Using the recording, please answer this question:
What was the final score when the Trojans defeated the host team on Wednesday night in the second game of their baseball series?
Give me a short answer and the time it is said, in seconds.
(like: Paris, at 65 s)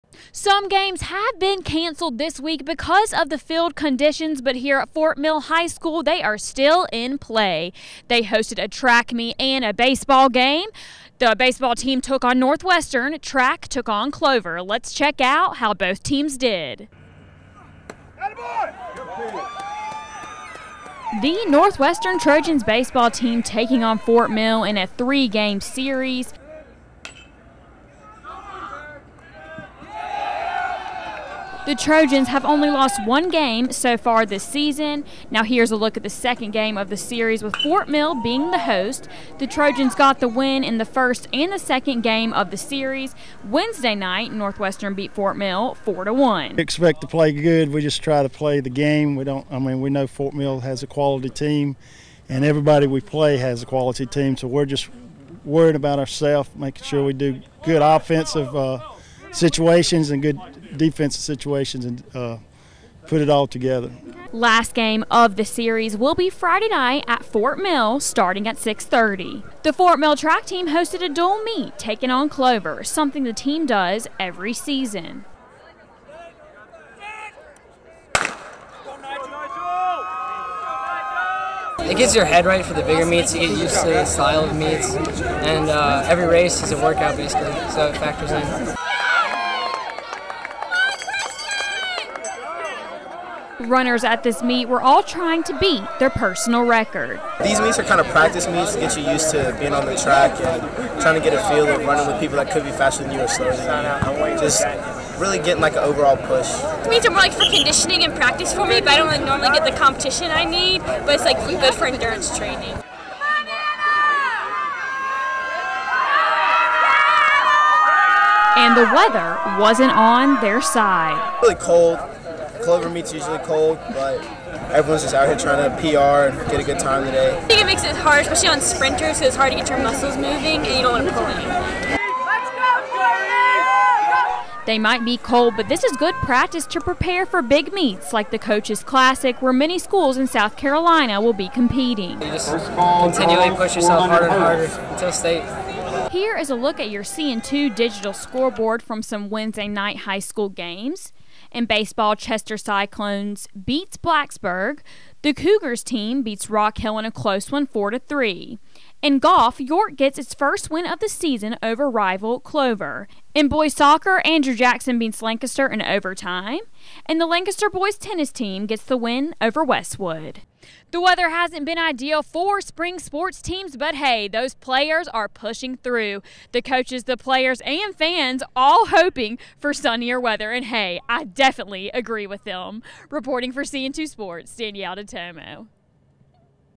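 4 to 1, at 45 s.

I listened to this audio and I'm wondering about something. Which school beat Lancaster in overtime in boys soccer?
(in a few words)
Andrew Jackson.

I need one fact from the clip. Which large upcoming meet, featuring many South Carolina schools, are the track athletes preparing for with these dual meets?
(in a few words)
Coaches Classic.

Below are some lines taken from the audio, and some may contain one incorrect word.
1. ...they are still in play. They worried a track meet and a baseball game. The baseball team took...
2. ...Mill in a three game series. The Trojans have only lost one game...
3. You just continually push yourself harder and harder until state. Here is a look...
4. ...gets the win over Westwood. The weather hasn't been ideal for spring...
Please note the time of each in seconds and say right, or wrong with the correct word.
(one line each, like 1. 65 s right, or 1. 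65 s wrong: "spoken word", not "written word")
1. 6 s wrong: "hosted", not "worried"
2. 24 s right
3. 142 s right
4. 168 s right.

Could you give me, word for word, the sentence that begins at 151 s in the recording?
In baseball, Chester Cyclones beats Blacksburg.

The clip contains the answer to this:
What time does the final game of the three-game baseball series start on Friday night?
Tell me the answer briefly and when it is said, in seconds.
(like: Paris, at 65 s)
6:30, at 68 s.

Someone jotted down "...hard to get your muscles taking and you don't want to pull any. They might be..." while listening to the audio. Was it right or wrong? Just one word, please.
wrong.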